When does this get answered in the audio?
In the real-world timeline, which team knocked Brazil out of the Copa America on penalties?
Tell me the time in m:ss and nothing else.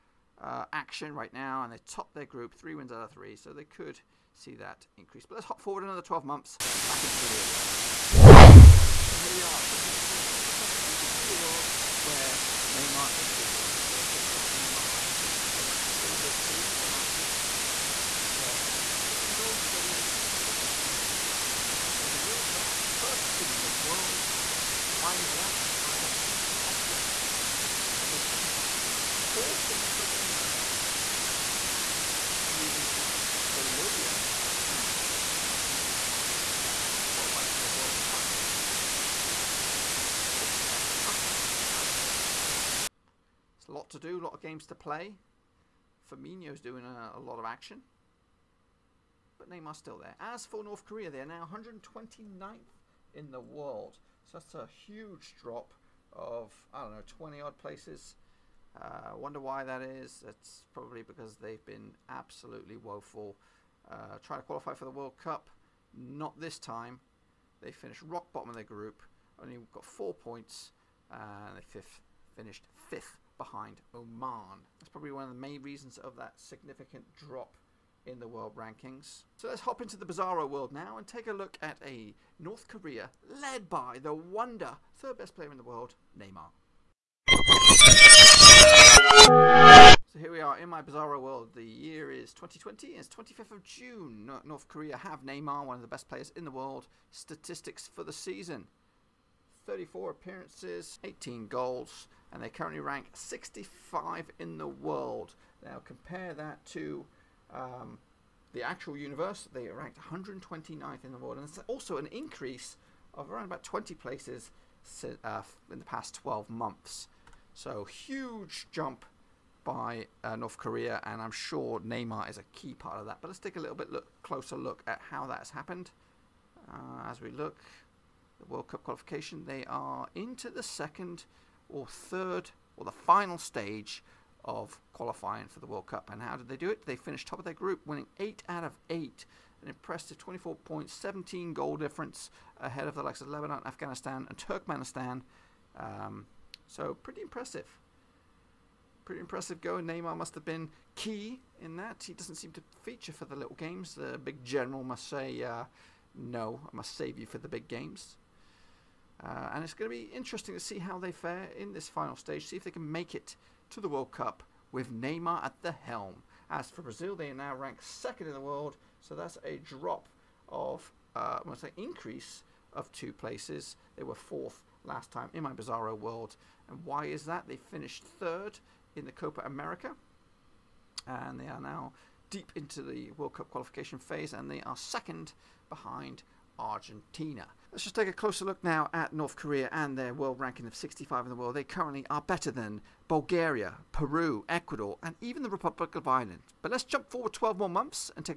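0:33.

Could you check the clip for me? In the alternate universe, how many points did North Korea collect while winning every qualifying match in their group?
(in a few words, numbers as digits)
24.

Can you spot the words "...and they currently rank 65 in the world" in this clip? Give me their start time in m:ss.
1:42.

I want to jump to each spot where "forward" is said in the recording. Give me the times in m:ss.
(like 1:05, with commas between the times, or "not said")
0:05, 3:17.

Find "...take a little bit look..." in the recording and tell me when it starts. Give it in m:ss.
2:03.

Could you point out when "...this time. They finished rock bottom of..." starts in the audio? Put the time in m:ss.
1:06.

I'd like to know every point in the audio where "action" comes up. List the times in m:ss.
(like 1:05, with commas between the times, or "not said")
0:00, 0:47.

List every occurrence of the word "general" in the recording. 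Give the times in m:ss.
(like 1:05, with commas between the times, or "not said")
2:34.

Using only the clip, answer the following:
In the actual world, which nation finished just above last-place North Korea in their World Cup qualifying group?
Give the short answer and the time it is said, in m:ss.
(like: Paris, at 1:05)
Oman, at 1:13.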